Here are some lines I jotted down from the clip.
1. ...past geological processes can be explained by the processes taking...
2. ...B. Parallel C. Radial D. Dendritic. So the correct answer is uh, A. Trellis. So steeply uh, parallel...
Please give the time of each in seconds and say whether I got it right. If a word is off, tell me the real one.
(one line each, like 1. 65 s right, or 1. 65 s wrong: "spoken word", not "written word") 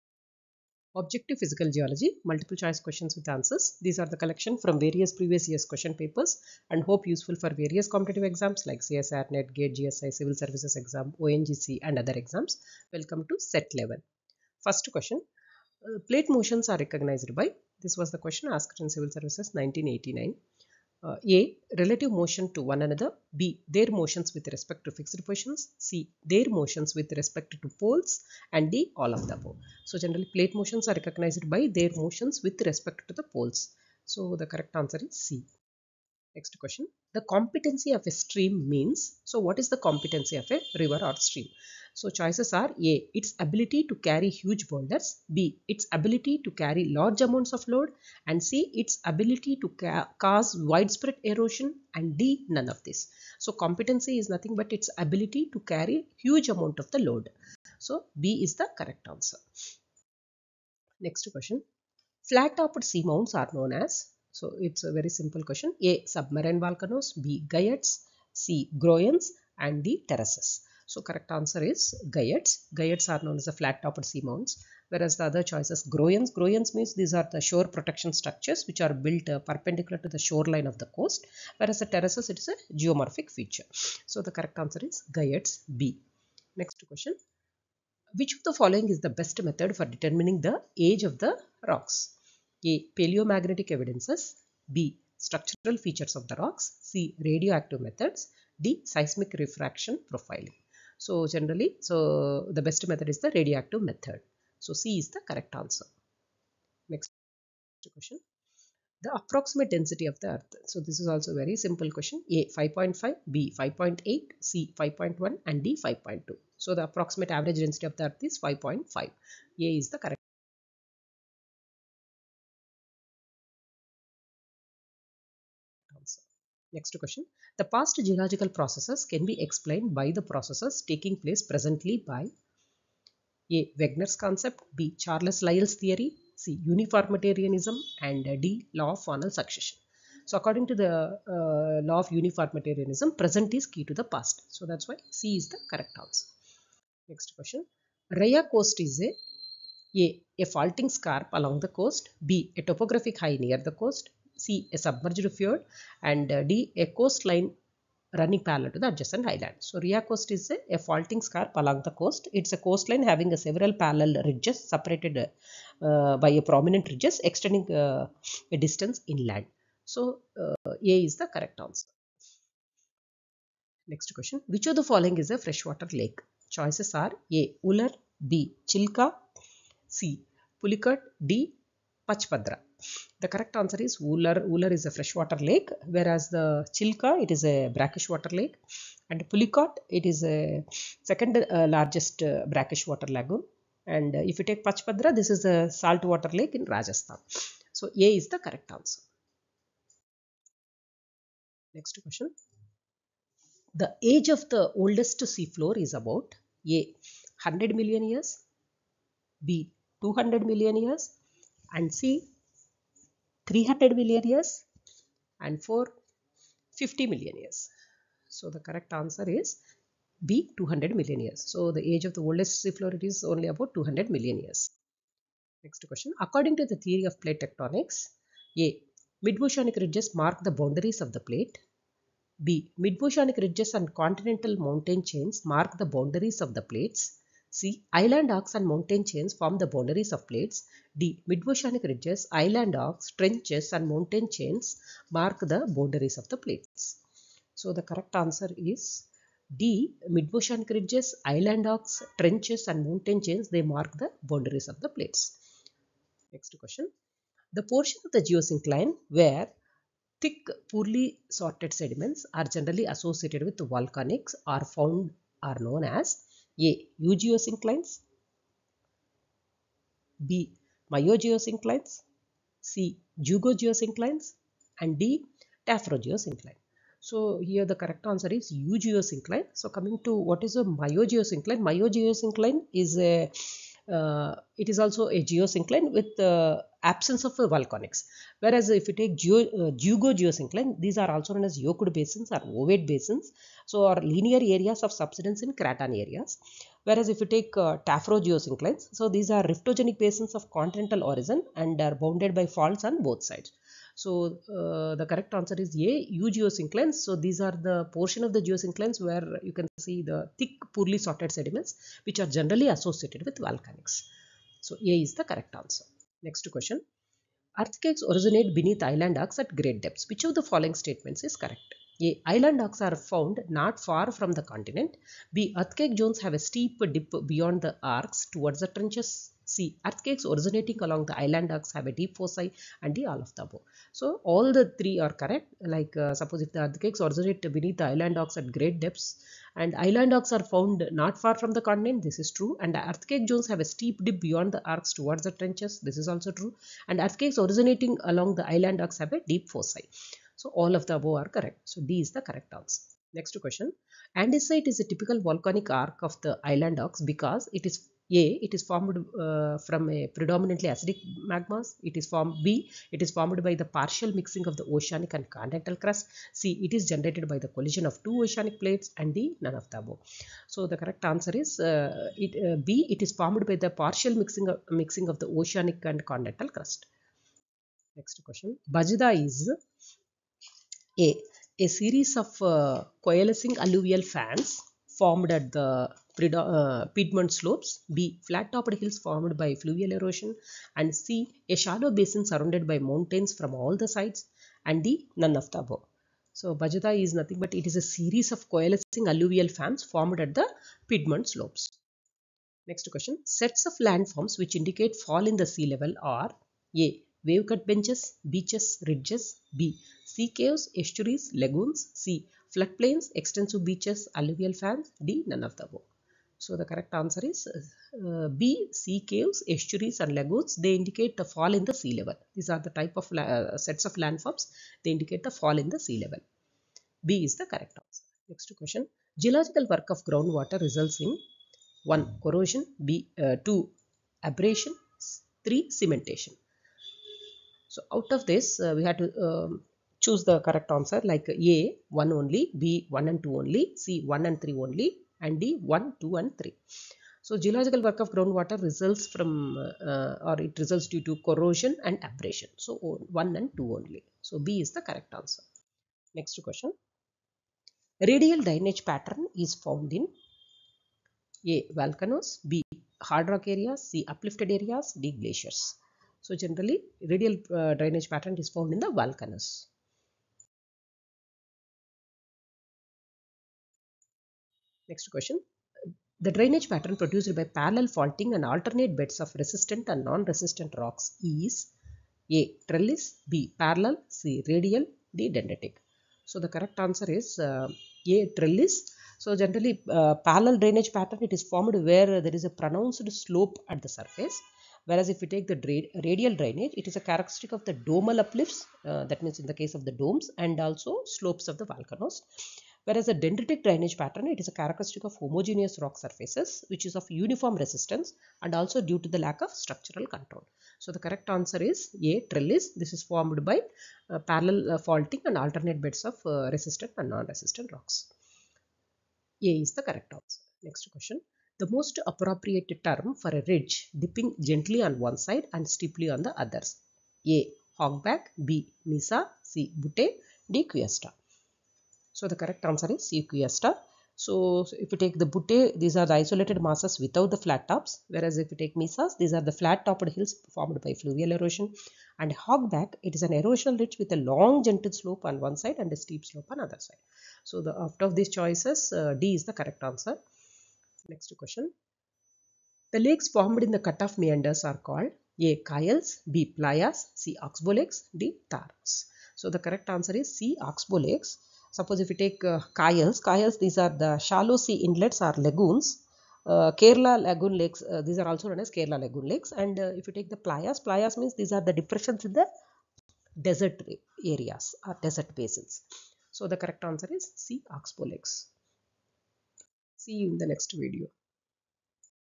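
1. 127 s right
2. 483 s wrong: "generally", not "steeply".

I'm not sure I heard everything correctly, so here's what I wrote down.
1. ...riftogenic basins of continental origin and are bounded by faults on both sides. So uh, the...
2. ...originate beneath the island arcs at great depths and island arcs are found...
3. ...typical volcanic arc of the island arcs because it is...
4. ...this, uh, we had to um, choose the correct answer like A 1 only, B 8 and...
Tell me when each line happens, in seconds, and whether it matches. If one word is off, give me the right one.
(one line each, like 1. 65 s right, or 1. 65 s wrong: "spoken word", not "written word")
1. 299 s right
2. 337 s right
3. 354 s right
4. 438 s wrong: "1", not "8".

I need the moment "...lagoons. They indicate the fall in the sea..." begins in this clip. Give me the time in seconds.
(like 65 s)
420 s.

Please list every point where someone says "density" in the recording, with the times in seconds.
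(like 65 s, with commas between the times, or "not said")
109 s, 117 s.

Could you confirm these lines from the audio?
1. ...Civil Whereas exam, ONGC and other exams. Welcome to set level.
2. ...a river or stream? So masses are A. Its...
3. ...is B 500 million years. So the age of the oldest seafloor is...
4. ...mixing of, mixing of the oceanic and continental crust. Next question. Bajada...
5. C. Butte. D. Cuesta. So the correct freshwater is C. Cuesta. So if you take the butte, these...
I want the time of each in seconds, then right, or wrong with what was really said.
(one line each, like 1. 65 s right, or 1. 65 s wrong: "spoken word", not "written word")
1. 10 s wrong: "Services", not "Whereas"
2. 40 s wrong: "choices", not "masses"
3. 219 s wrong: "200", not "500"
4. 374 s right
5. 529 s wrong: "answer", not "freshwater".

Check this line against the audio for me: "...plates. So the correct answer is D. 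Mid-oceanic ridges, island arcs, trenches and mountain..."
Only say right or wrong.
right.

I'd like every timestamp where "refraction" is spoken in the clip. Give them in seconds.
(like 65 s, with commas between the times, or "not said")
99 s.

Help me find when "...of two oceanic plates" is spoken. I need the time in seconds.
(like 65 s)
367 s.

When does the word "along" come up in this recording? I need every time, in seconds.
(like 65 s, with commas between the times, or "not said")
151 s, 161 s, 330 s, 348 s.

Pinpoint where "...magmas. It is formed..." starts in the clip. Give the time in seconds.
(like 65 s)
361 s.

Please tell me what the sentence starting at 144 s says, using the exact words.
So that's why C is the correct answer.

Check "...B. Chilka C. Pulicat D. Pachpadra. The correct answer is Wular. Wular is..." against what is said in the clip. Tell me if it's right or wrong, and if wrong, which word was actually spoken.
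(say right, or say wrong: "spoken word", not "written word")
right.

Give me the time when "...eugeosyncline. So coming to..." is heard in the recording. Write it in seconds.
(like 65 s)
278 s.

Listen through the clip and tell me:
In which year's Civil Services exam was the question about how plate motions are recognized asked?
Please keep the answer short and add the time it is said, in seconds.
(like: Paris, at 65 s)
1989, at 19 s.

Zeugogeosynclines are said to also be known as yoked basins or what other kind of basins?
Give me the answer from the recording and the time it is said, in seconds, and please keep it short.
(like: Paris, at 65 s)
Ovate basins, at 292 s.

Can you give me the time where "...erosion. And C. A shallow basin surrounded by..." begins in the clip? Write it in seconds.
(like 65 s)
389 s.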